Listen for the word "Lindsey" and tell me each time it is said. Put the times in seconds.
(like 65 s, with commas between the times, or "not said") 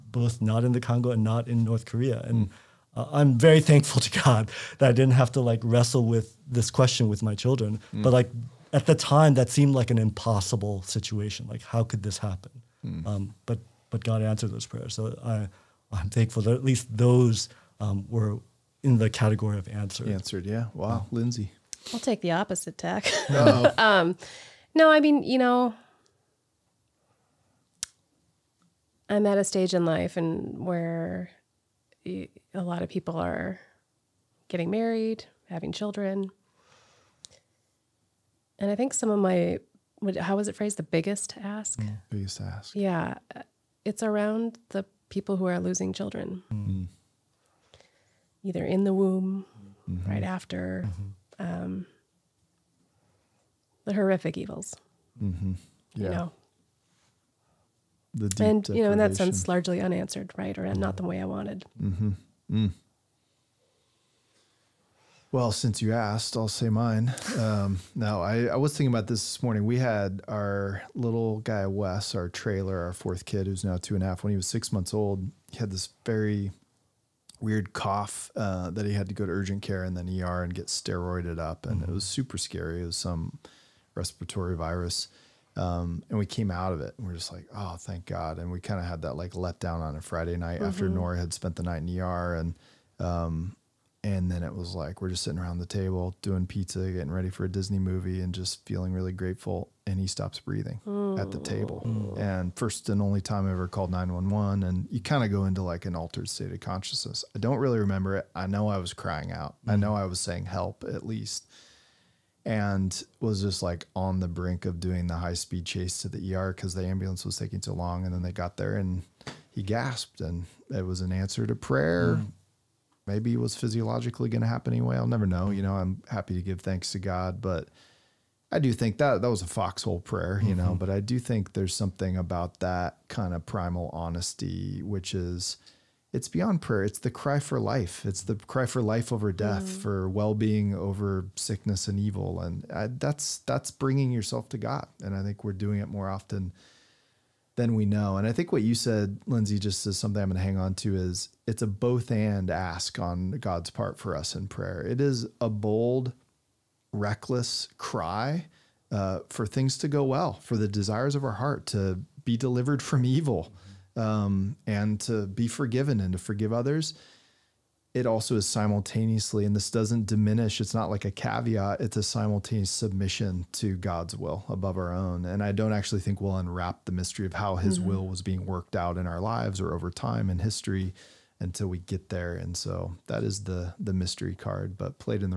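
21 s, 149 s.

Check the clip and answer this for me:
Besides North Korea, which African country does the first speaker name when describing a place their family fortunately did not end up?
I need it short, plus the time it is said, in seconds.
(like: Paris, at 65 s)
Congo, at 0 s.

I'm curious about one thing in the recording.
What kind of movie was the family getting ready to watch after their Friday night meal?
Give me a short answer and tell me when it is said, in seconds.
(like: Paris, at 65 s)
A Disney movie, at 97 s.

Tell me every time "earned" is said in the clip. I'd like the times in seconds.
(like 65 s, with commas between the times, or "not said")
not said.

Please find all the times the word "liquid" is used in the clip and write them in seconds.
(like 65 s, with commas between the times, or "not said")
not said.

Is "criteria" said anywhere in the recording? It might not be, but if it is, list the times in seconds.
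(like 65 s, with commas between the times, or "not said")
not said.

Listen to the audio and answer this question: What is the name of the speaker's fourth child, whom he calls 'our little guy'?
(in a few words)
Wes.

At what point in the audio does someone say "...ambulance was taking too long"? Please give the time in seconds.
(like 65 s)
116 s.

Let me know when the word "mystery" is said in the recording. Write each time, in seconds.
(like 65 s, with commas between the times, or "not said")
176 s, 183 s.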